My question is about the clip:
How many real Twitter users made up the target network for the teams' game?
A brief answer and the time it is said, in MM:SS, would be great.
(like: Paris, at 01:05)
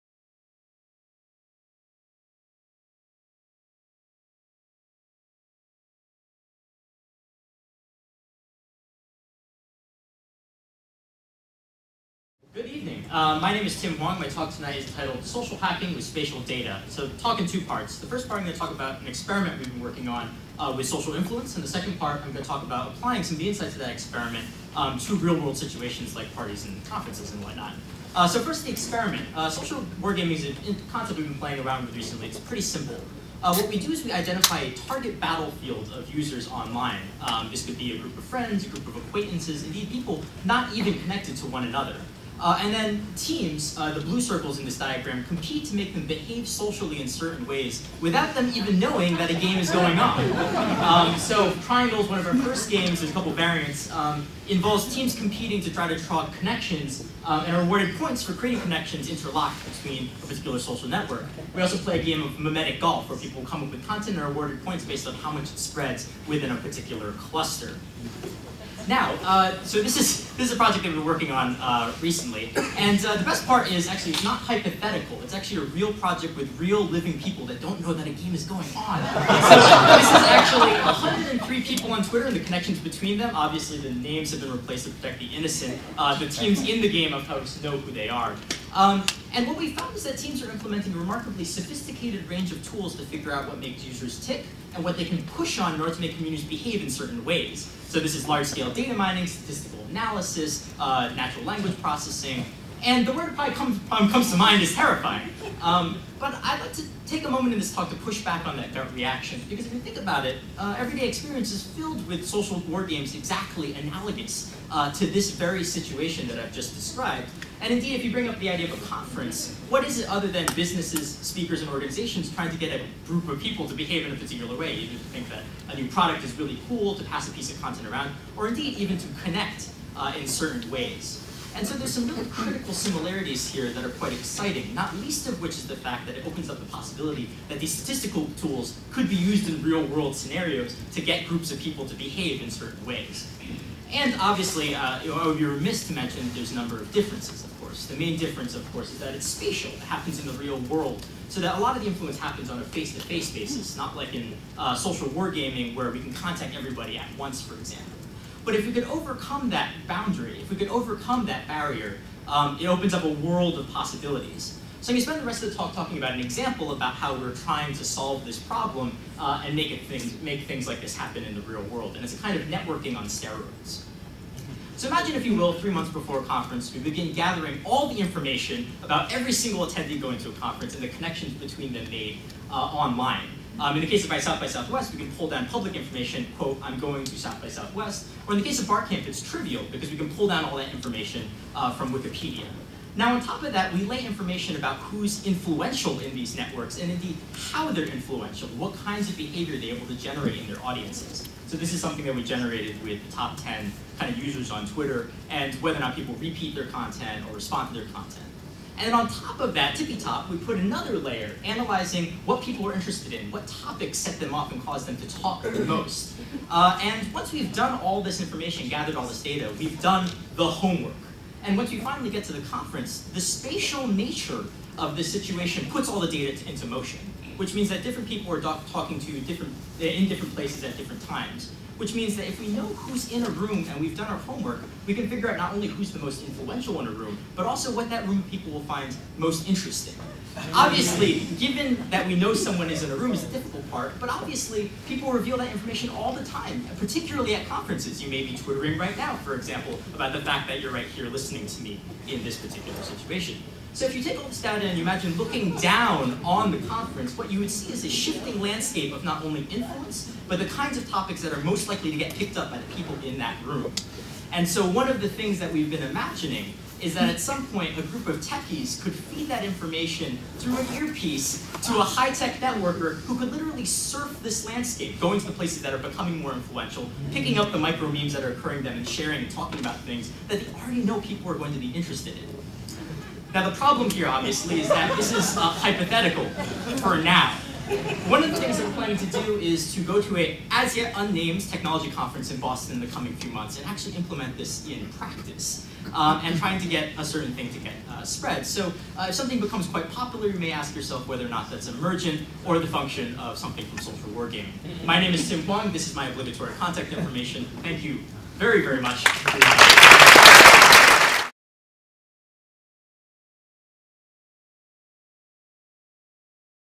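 103, at 01:20.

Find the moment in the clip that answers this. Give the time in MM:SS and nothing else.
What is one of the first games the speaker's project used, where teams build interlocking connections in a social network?
00:51.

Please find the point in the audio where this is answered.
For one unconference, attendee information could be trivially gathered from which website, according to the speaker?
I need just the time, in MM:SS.
03:11.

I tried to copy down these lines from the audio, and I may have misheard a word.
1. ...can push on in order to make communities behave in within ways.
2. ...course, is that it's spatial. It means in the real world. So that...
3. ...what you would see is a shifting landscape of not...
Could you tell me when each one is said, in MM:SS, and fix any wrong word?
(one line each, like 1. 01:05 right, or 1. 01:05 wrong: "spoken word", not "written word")
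1. 01:35 wrong: "certain", not "within"
2. 02:28 wrong: "happens", not "means"
3. 04:17 right.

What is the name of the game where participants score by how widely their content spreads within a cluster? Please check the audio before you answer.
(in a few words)
mimetic golf.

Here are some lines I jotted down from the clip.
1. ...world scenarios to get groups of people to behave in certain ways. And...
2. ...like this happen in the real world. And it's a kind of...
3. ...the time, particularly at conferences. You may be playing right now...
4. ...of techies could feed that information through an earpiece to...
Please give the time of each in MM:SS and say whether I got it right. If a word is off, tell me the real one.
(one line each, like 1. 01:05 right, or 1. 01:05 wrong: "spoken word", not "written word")
1. 02:19 right
2. 02:50 right
3. 04:06 wrong: "twittering", not "playing"
4. 04:28 right.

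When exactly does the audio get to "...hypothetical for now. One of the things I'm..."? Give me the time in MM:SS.
04:45.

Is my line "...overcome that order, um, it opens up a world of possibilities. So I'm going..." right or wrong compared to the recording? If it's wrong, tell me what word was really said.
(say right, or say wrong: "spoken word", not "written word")
wrong: "barrier", not "order".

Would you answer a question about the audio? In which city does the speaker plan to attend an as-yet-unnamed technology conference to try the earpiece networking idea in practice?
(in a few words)
Boston.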